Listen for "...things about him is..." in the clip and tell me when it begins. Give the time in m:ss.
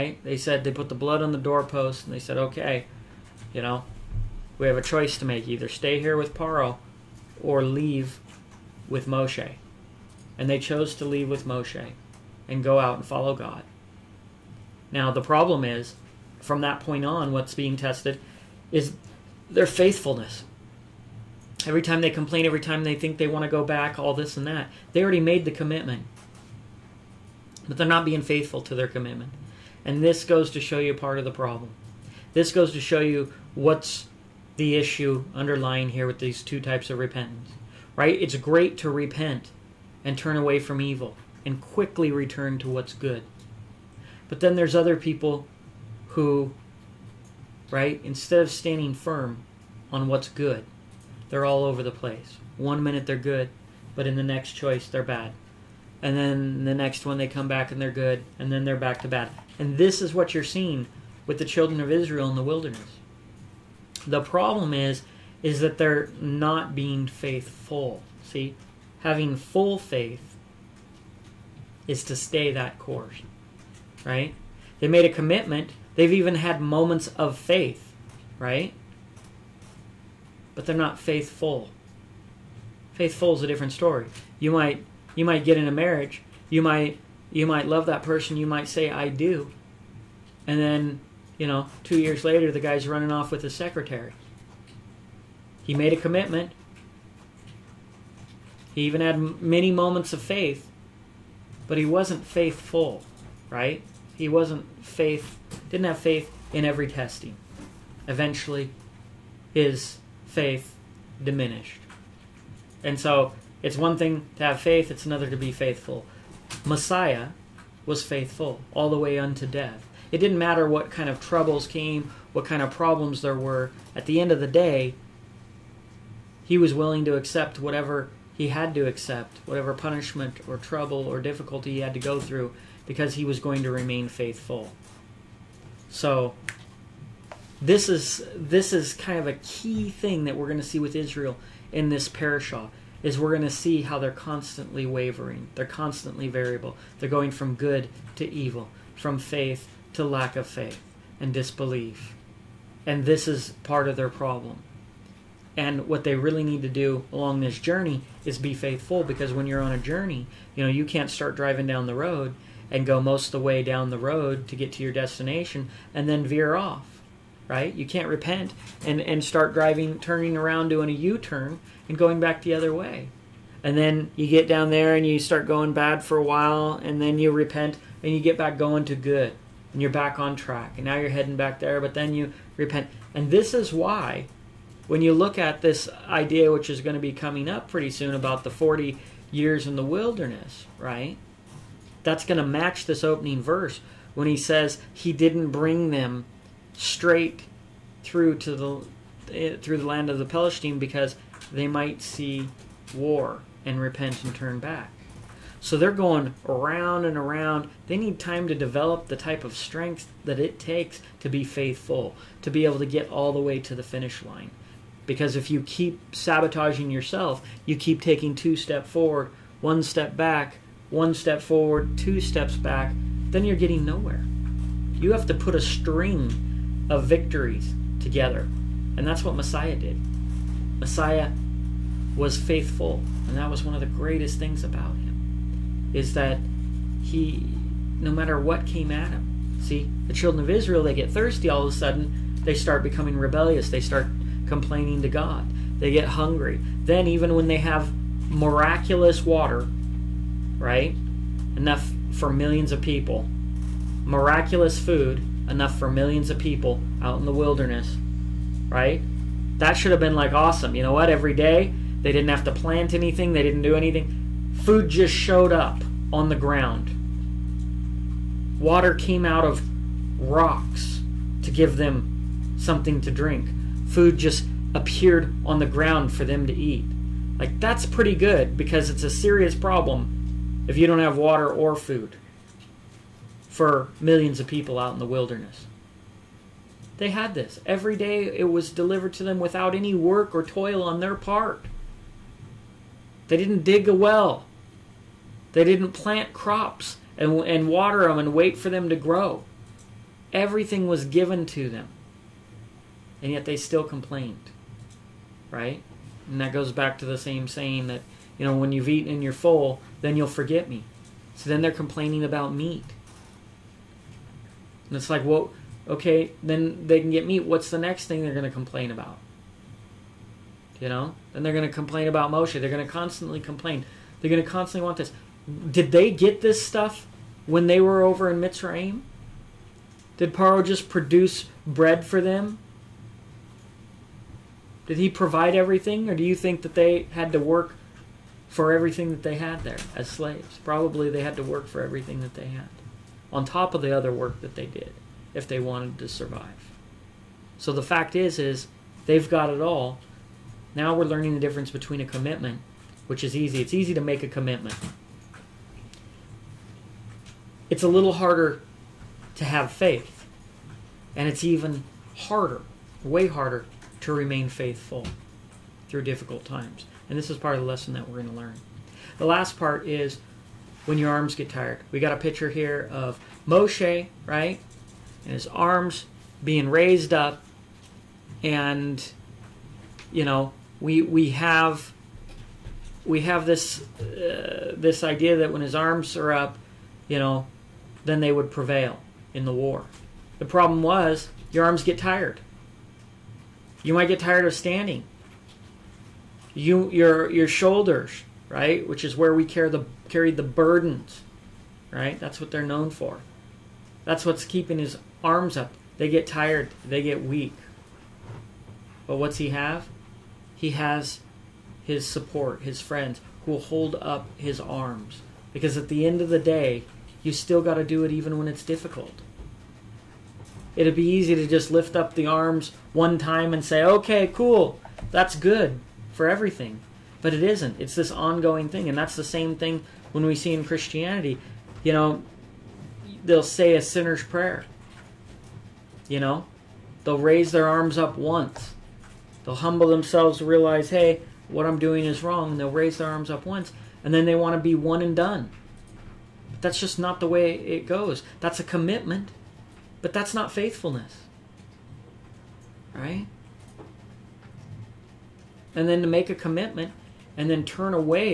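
3:54.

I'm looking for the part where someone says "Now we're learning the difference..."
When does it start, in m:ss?
5:50.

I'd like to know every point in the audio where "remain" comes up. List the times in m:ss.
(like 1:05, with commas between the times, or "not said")
2:13, 6:04.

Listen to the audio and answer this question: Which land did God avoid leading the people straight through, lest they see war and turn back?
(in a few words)
The land of the Palestine.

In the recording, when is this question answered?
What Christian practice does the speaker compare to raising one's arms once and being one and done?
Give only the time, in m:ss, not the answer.
7:13.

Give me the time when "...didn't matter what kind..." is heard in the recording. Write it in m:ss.
2:00.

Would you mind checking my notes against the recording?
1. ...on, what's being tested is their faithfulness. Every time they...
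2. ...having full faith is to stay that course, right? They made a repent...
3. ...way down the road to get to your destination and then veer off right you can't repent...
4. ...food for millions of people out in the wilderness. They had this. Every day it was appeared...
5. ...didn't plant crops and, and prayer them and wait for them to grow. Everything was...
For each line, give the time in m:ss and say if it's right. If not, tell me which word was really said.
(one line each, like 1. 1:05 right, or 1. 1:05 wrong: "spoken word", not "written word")
1. 0:17 right
2. 1:09 wrong: "commitment", not "repent"
3. 2:43 right
4. 4:41 wrong: "delivered", not "appeared"
5. 4:55 wrong: "water", not "prayer".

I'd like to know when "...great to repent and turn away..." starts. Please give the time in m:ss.
0:38.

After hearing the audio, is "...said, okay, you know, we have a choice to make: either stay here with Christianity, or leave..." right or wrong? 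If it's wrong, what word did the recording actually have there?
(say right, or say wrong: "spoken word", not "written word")
wrong: "Paro", not "Christianity".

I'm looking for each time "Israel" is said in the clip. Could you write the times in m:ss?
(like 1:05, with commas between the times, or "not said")
1:01, 2:20, 4:00.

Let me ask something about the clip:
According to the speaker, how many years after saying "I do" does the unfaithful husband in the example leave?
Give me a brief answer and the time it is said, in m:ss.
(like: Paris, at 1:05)
2, at 1:31.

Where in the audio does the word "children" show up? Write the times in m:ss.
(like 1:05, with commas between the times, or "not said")
1:01, 4:00.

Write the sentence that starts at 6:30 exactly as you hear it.
The problem was your arms get tired.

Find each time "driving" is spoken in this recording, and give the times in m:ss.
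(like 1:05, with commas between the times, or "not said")
2:41, 2:49.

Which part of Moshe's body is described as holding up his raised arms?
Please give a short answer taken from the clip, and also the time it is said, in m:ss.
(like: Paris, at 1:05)
Shoulders, at 6:37.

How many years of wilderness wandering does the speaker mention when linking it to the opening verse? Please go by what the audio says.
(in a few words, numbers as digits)
40.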